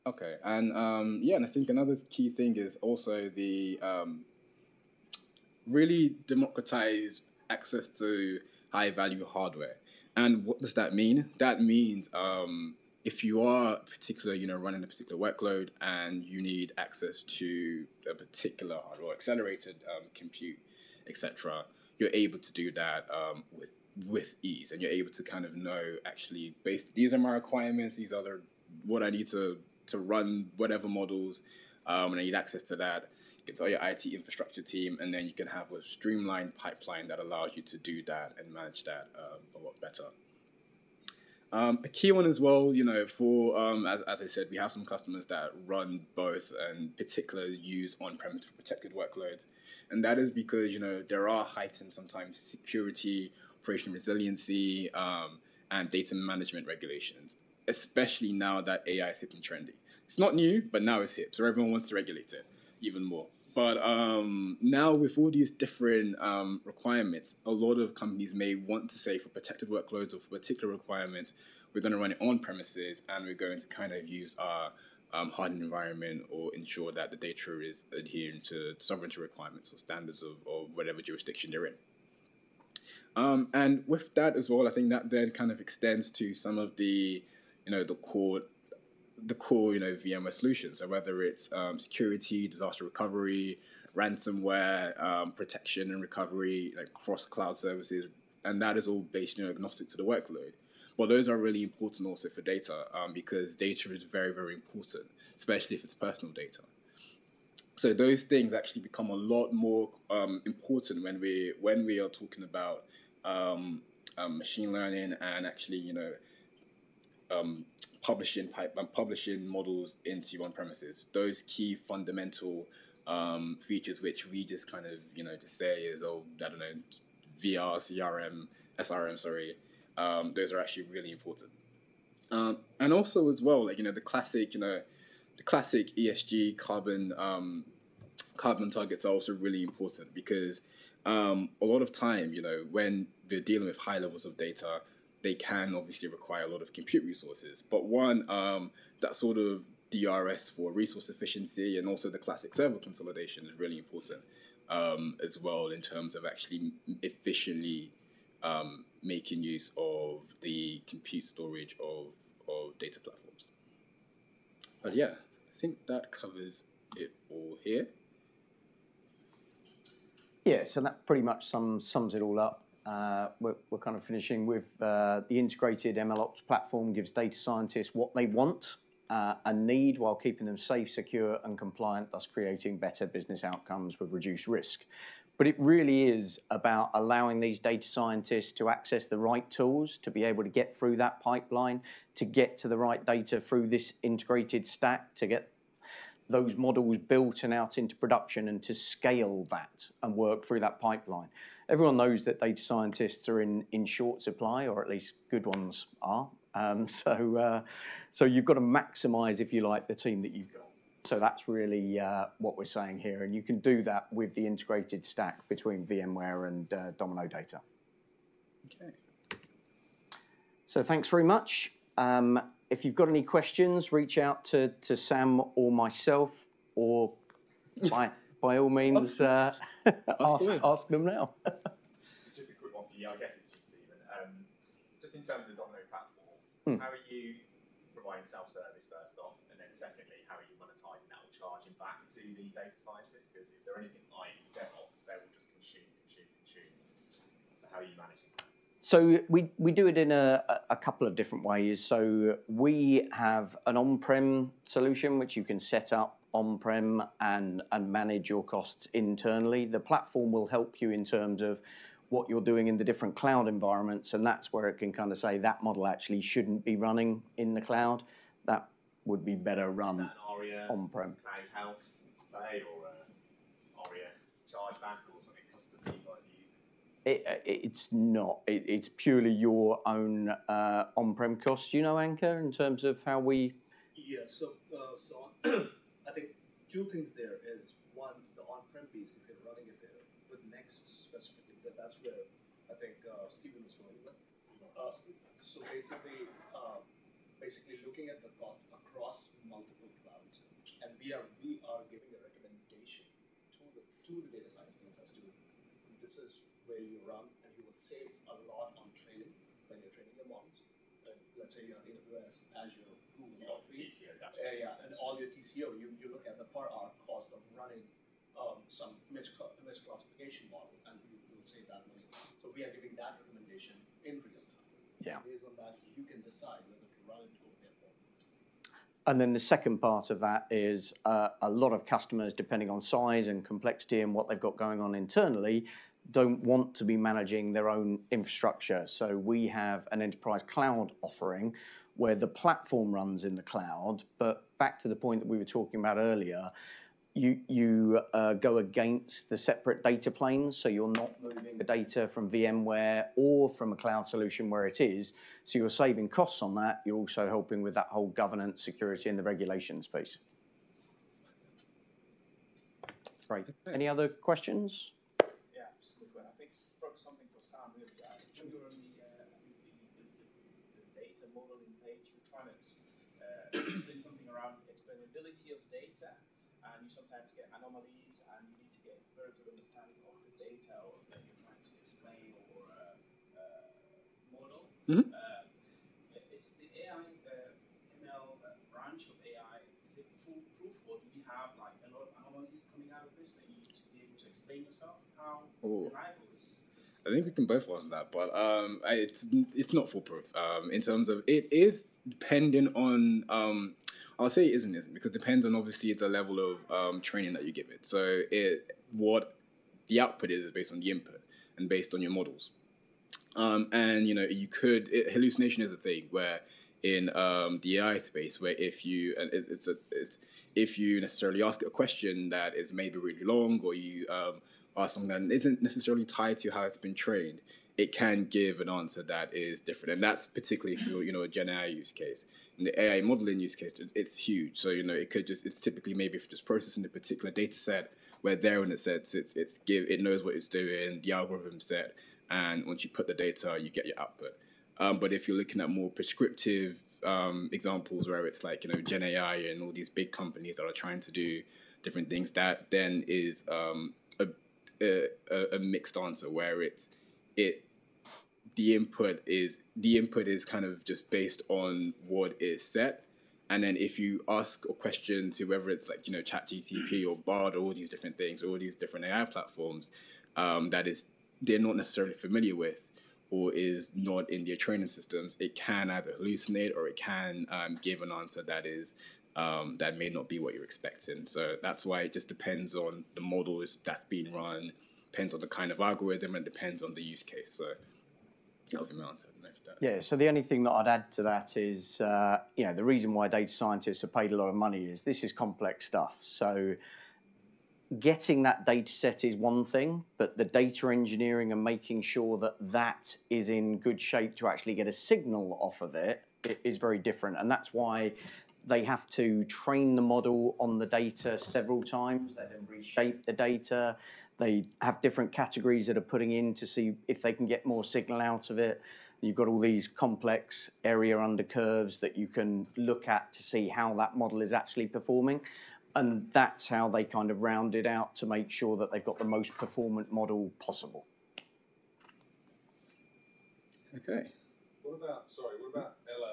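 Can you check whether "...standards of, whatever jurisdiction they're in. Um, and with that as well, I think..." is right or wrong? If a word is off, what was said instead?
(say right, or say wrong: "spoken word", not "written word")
right.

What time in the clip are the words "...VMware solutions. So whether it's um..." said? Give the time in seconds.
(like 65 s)
89 s.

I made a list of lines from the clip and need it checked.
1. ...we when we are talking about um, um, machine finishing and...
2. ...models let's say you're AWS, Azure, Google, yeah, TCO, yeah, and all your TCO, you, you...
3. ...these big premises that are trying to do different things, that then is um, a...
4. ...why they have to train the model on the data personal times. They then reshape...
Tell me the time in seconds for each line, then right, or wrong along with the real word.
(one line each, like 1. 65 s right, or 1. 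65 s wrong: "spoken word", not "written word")
1. 111 s wrong: "learning", not "finishing"
2. 310 s right
3. 449 s wrong: "companies", not "premises"
4. 507 s wrong: "several", not "personal".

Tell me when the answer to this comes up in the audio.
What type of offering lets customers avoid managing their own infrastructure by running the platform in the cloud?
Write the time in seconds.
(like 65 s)
340 s.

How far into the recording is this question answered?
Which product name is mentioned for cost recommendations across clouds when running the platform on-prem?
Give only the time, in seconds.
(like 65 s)
290 s.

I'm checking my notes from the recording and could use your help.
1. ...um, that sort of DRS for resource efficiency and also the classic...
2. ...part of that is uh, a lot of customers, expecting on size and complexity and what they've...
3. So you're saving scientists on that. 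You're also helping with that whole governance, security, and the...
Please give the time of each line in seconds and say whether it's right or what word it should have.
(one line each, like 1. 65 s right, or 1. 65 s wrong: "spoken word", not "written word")
1. 148 s right
2. 329 s wrong: "depending", not "expecting"
3. 355 s wrong: "costs", not "scientists".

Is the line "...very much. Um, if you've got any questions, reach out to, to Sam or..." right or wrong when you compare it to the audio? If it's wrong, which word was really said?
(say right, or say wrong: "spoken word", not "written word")
right.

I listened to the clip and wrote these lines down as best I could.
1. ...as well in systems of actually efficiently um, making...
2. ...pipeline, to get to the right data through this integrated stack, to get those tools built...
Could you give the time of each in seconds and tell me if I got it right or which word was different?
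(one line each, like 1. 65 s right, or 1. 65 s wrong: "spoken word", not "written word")
1. 155 s wrong: "terms", not "systems"
2. 191 s wrong: "models", not "tools".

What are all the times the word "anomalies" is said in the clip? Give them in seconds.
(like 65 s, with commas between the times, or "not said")
377 s, 392 s.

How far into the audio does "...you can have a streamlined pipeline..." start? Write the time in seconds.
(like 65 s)
35 s.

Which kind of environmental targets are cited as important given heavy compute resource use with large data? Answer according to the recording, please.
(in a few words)
Carbon targets.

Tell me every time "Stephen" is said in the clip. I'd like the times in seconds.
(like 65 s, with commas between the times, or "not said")
233 s, 293 s.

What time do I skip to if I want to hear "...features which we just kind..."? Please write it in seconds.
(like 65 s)
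123 s.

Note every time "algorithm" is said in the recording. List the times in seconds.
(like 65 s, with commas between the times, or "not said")
441 s, 485 s.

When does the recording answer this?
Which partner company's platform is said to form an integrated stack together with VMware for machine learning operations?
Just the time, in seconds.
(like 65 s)
216 s.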